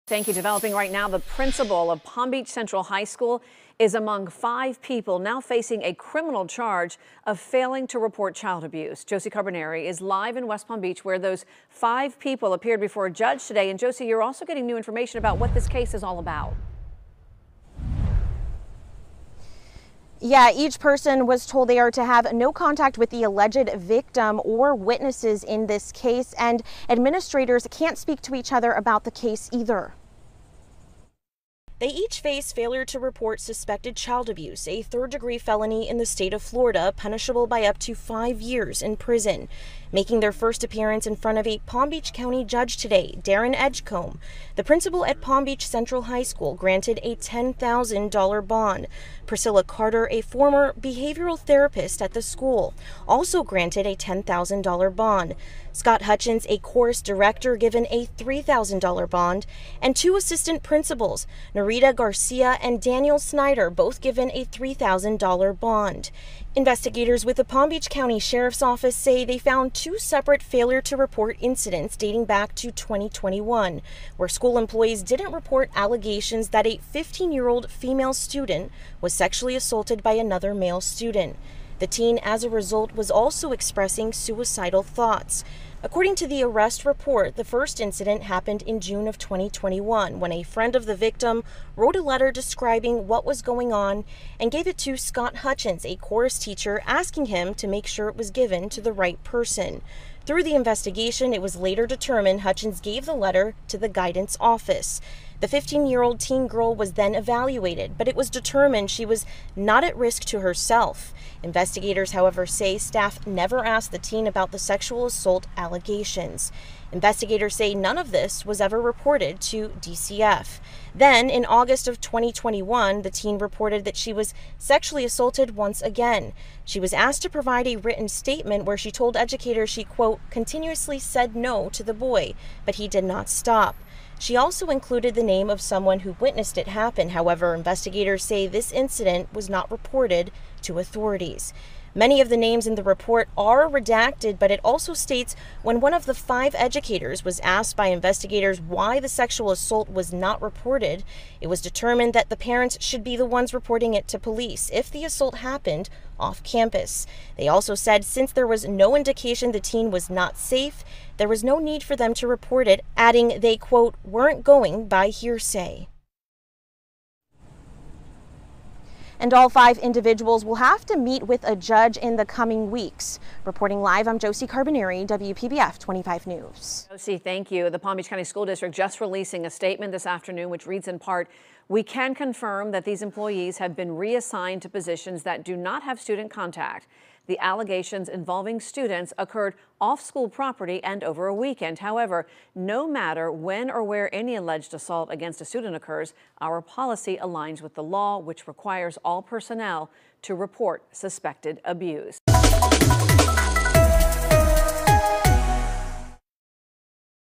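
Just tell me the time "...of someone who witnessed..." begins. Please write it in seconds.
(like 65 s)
135 s.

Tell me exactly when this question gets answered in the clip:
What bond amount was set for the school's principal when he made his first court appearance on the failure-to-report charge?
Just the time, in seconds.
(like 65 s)
47 s.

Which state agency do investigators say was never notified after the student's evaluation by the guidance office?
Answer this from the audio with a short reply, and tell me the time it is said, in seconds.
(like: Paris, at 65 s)
DCF, at 119 s.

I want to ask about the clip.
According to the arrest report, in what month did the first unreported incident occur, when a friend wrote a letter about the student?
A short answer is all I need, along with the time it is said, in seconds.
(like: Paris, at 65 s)
June, at 88 s.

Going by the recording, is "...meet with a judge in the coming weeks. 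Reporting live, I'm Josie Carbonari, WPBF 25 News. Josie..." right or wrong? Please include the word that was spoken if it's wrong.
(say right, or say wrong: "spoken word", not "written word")
right.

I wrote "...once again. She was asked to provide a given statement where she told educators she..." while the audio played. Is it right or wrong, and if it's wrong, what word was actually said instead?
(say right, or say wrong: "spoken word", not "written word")
wrong: "written", not "given".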